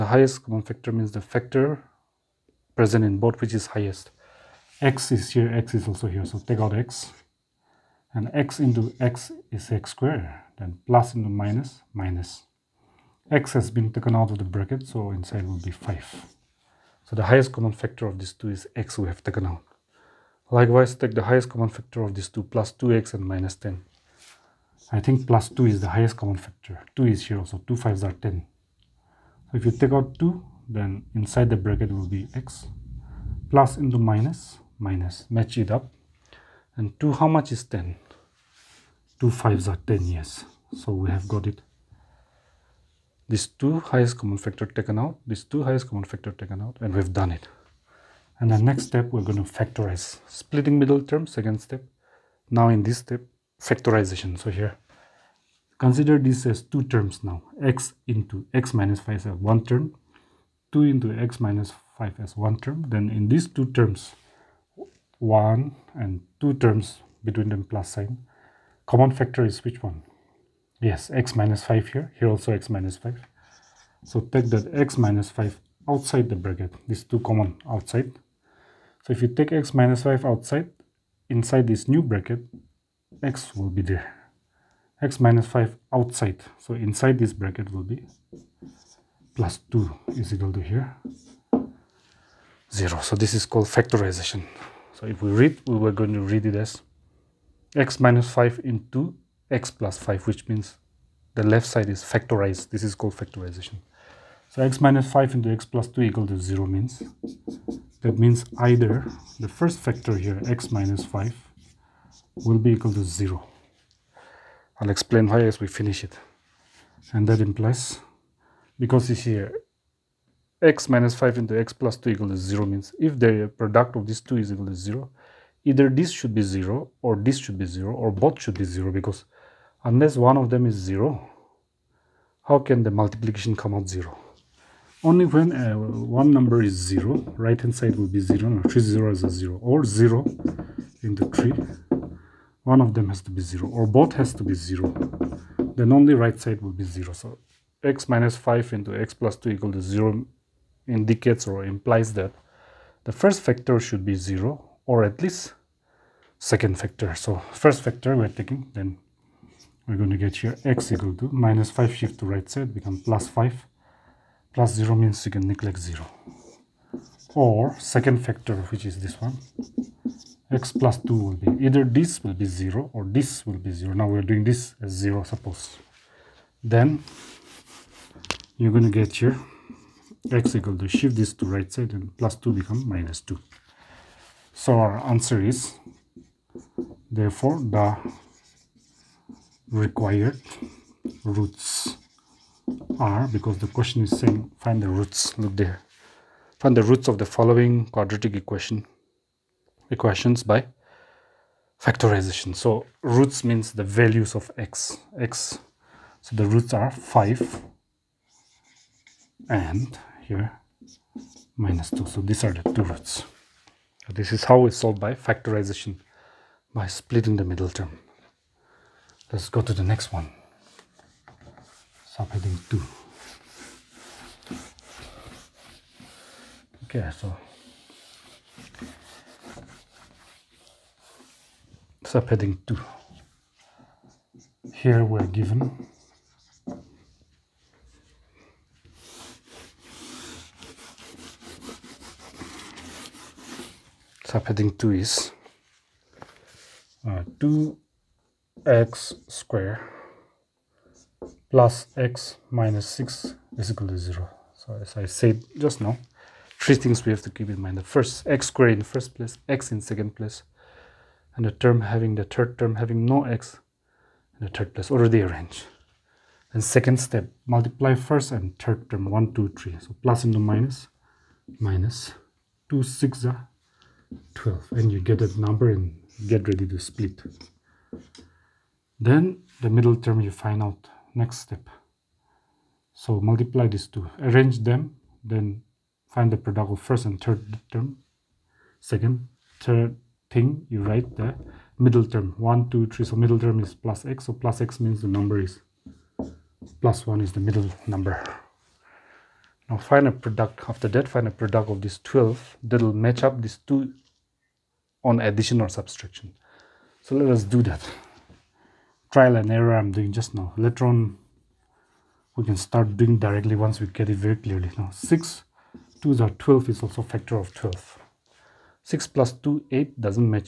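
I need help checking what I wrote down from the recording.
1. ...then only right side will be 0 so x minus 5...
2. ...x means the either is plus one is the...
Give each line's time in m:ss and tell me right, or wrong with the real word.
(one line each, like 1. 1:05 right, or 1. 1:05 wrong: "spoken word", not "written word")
1. 2:25 right
2. 4:54 wrong: "number", not "either".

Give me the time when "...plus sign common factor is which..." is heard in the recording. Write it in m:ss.
1:07.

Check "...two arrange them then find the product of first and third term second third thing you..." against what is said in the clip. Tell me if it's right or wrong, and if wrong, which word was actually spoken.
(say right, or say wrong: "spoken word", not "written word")
right.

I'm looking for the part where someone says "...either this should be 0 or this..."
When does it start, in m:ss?
2:05.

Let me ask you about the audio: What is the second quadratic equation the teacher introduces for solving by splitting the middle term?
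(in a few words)
2x^2 + x - 6 = 0.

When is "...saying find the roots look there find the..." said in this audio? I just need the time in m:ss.
3:14.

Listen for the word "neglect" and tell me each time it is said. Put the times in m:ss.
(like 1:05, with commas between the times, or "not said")
2:45.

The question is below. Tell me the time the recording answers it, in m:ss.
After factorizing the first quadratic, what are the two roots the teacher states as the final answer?
3:26.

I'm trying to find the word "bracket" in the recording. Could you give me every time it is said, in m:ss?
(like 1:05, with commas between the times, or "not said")
0:14, 0:31, 1:16, 1:22, 1:27.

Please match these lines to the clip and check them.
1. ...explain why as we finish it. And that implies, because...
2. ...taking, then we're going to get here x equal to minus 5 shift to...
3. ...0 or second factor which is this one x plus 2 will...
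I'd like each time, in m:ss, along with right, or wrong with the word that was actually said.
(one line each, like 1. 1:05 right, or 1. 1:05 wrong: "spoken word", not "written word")
1. 1:54 right
2. 2:38 right
3. 2:45 right.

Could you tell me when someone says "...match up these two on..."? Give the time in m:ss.
5:02.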